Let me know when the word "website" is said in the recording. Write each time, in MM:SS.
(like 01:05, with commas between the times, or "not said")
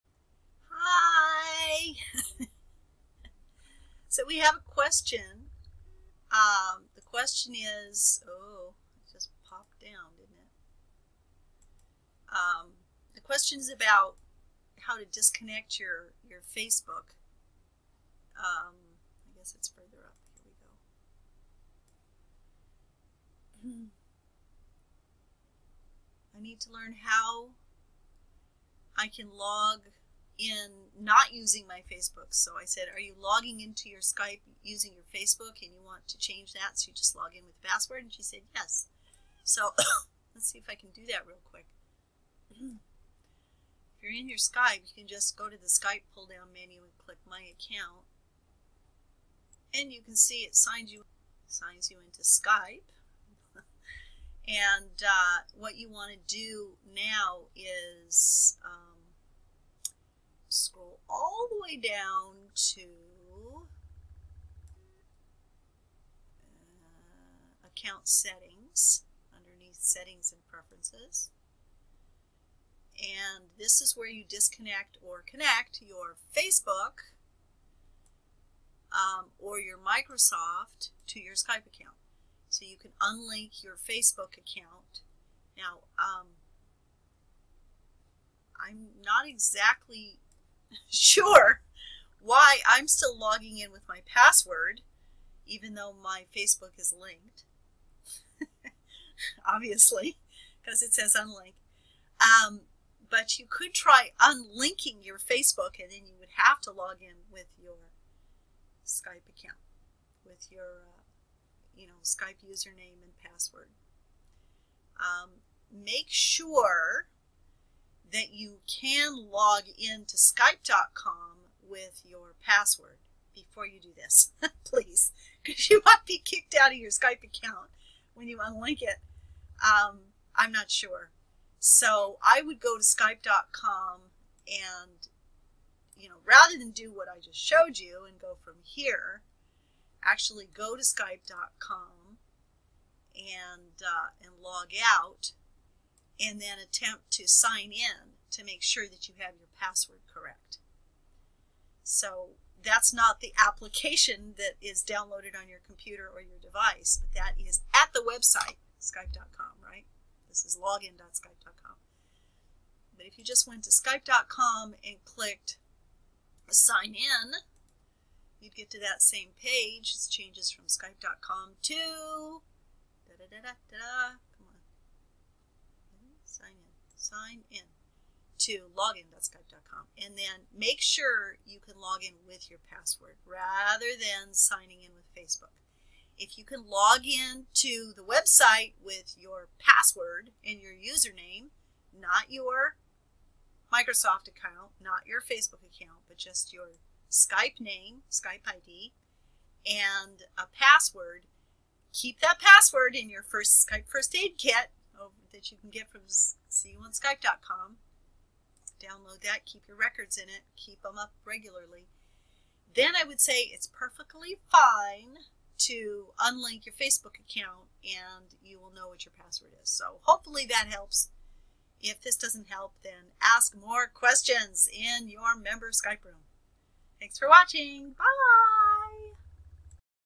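02:37, 03:08.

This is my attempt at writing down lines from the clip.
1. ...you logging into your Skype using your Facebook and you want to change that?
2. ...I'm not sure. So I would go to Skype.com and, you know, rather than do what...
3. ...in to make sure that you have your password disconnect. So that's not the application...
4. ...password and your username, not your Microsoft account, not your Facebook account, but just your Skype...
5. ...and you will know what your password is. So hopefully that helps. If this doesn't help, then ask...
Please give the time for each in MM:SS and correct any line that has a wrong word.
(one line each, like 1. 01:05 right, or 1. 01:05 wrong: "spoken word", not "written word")
1. 00:32 right
2. 02:10 right
3. 02:27 wrong: "correct", not "disconnect"
4. 03:09 right
5. 03:37 right.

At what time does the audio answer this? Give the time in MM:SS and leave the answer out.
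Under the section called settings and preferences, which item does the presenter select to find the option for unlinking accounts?
01:07.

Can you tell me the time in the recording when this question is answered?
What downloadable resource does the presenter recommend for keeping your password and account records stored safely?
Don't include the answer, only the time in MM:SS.
03:23.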